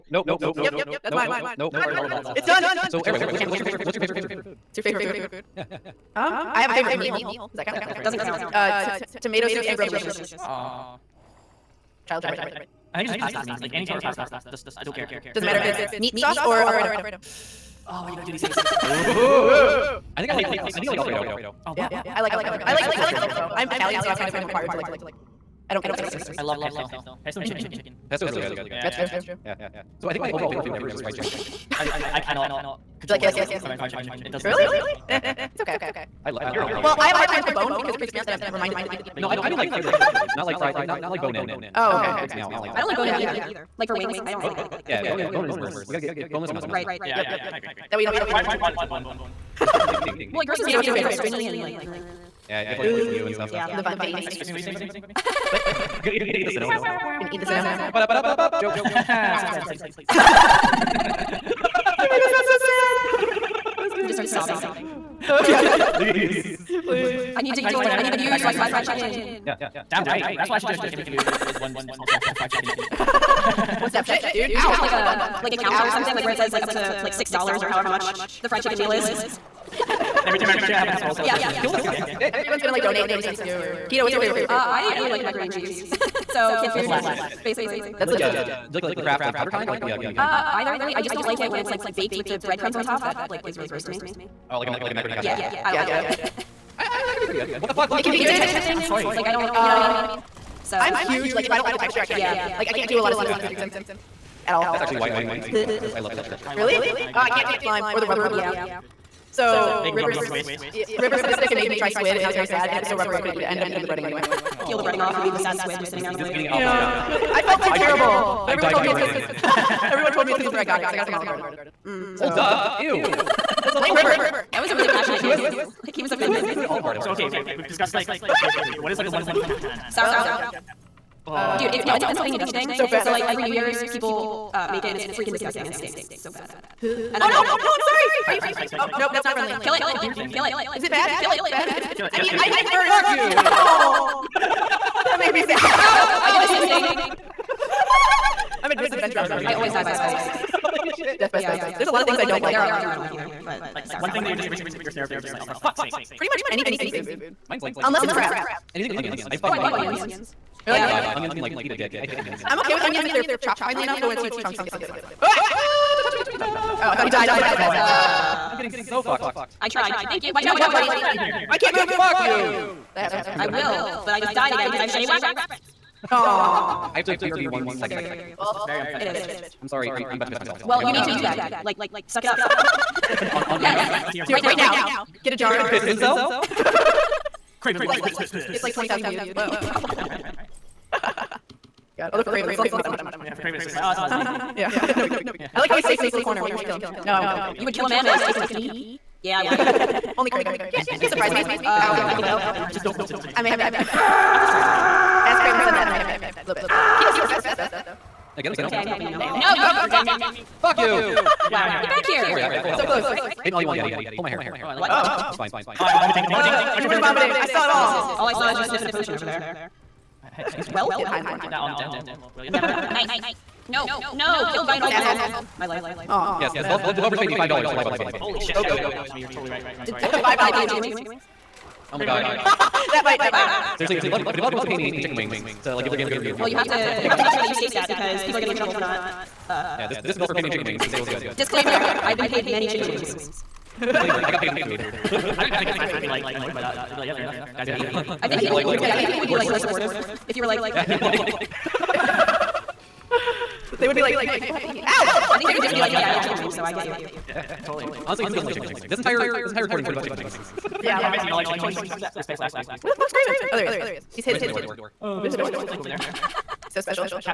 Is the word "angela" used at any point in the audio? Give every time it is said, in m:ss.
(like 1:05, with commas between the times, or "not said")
not said.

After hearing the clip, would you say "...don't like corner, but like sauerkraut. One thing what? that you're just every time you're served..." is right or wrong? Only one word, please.
wrong.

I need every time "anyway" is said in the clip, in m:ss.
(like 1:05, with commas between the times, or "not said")
0:03, 1:54.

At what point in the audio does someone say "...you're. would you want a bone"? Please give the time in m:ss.
0:48.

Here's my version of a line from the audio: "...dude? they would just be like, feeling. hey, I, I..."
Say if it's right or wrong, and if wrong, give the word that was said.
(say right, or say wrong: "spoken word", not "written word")
right.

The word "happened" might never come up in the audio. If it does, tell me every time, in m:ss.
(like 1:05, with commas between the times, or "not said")
2:53, 3:22.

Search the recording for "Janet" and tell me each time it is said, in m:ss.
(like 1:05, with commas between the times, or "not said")
not said.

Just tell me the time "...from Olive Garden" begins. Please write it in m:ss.
2:01.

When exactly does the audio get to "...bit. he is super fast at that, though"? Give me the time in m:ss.
3:26.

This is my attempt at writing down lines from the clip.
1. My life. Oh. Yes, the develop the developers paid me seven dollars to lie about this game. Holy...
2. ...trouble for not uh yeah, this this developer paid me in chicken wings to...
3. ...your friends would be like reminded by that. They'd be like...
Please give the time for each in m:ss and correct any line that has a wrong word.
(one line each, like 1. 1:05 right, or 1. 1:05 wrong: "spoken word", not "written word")
1. 3:45 wrong: "five", not "seven"
2. 3:58 right
3. 4:05 wrong: "annoyed", not "reminded".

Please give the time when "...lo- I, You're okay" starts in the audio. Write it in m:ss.
0:36.